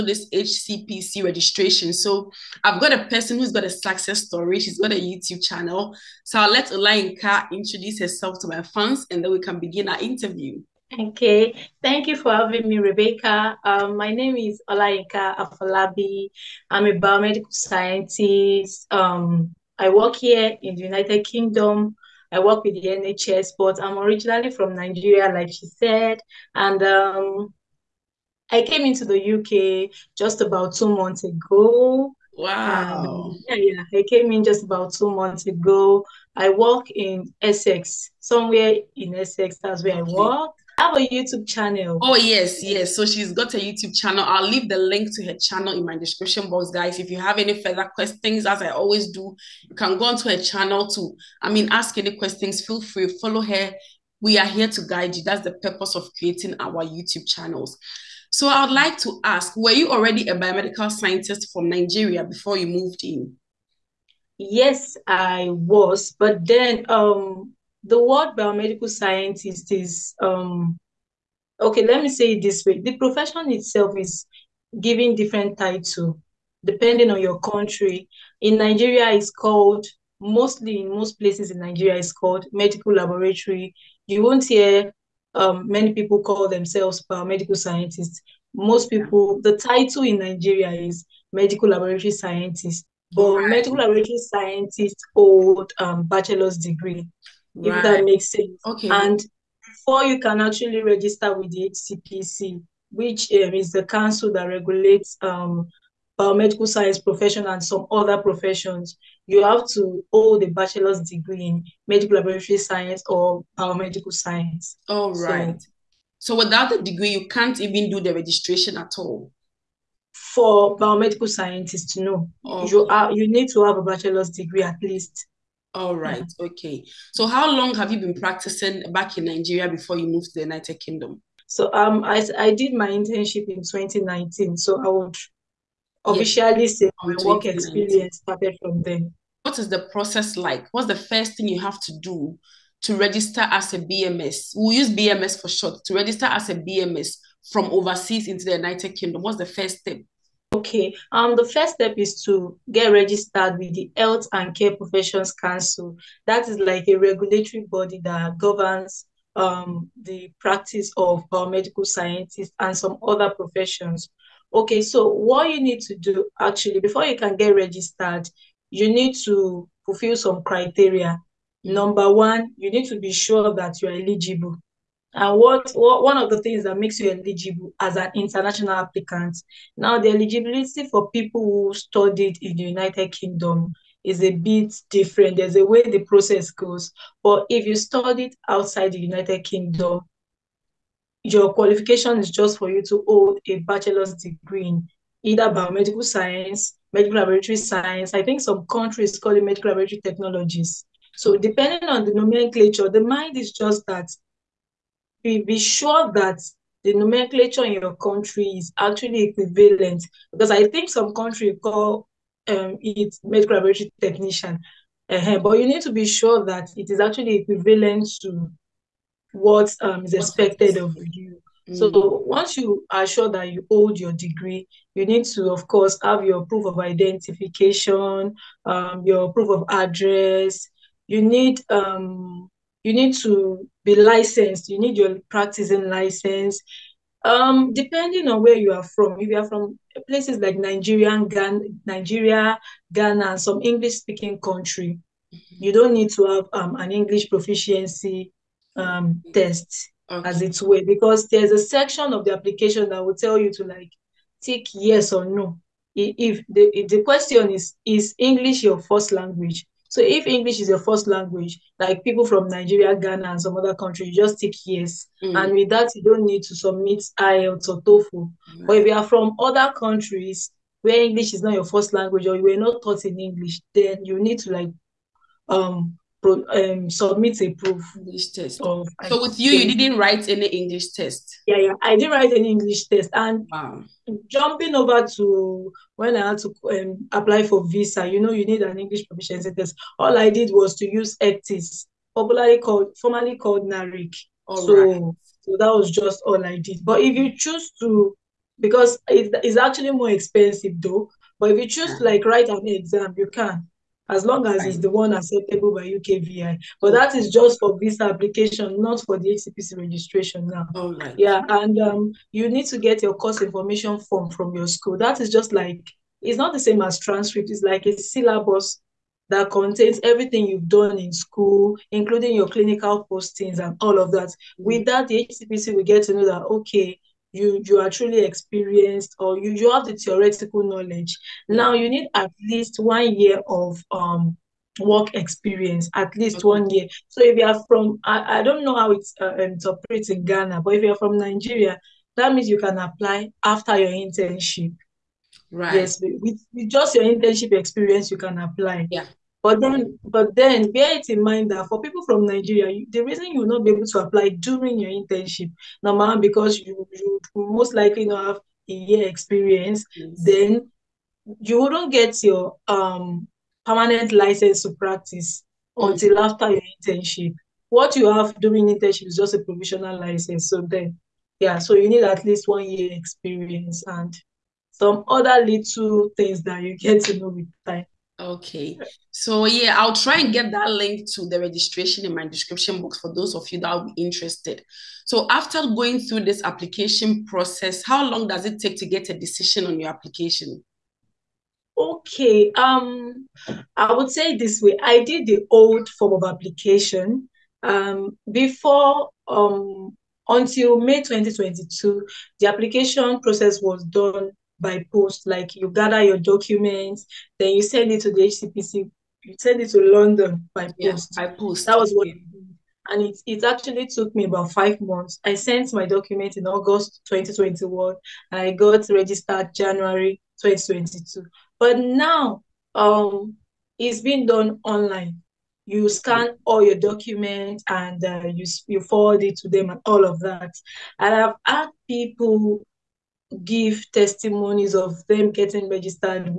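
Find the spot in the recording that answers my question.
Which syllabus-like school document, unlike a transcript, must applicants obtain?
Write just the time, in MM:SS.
05:13.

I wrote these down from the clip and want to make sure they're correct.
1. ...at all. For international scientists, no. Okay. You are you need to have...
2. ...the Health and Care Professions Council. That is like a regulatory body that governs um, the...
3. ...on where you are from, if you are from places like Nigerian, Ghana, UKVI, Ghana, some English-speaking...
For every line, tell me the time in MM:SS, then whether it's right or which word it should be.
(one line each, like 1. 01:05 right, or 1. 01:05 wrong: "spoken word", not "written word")
1. 01:58 wrong: "biomedical", not "international"
2. 02:33 right
3. 03:58 wrong: "Nigeria", not "UKVI".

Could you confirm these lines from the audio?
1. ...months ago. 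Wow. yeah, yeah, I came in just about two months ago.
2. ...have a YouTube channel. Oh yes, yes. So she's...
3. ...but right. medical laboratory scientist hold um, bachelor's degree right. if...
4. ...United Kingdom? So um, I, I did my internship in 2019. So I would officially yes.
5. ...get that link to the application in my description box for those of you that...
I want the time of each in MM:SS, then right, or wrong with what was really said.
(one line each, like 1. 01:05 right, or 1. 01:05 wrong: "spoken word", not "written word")
1. 00:30 right
2. 00:40 right
3. 01:33 right
4. 02:10 right
5. 06:20 wrong: "registration", not "application".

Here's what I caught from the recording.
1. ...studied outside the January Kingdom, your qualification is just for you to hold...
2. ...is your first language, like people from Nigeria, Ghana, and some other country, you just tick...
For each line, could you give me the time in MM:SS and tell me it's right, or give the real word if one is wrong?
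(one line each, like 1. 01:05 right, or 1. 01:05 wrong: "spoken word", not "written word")
1. 03:07 wrong: "United", not "January"
2. 04:20 right.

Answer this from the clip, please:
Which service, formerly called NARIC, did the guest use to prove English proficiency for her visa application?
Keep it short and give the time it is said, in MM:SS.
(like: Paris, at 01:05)
Ecctis, at 04:51.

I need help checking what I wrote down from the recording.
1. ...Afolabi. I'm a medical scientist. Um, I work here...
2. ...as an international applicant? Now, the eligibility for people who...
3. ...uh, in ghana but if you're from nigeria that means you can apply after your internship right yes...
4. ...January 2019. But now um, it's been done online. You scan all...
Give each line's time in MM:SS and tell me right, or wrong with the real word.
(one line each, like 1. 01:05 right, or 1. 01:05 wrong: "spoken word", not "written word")
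1. 00:15 wrong: "biomedical", not "medical"
2. 02:57 right
3. 05:39 right
4. 06:59 wrong: "2022", not "2019".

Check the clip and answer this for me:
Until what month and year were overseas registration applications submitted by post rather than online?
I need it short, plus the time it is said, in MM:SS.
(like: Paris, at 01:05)
May 2022, at 06:40.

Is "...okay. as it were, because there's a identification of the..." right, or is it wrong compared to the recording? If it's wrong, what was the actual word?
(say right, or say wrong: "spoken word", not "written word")
wrong: "section", not "identification".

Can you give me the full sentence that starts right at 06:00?
then you wouldn't get your um, permanent license to practice mm-hmm.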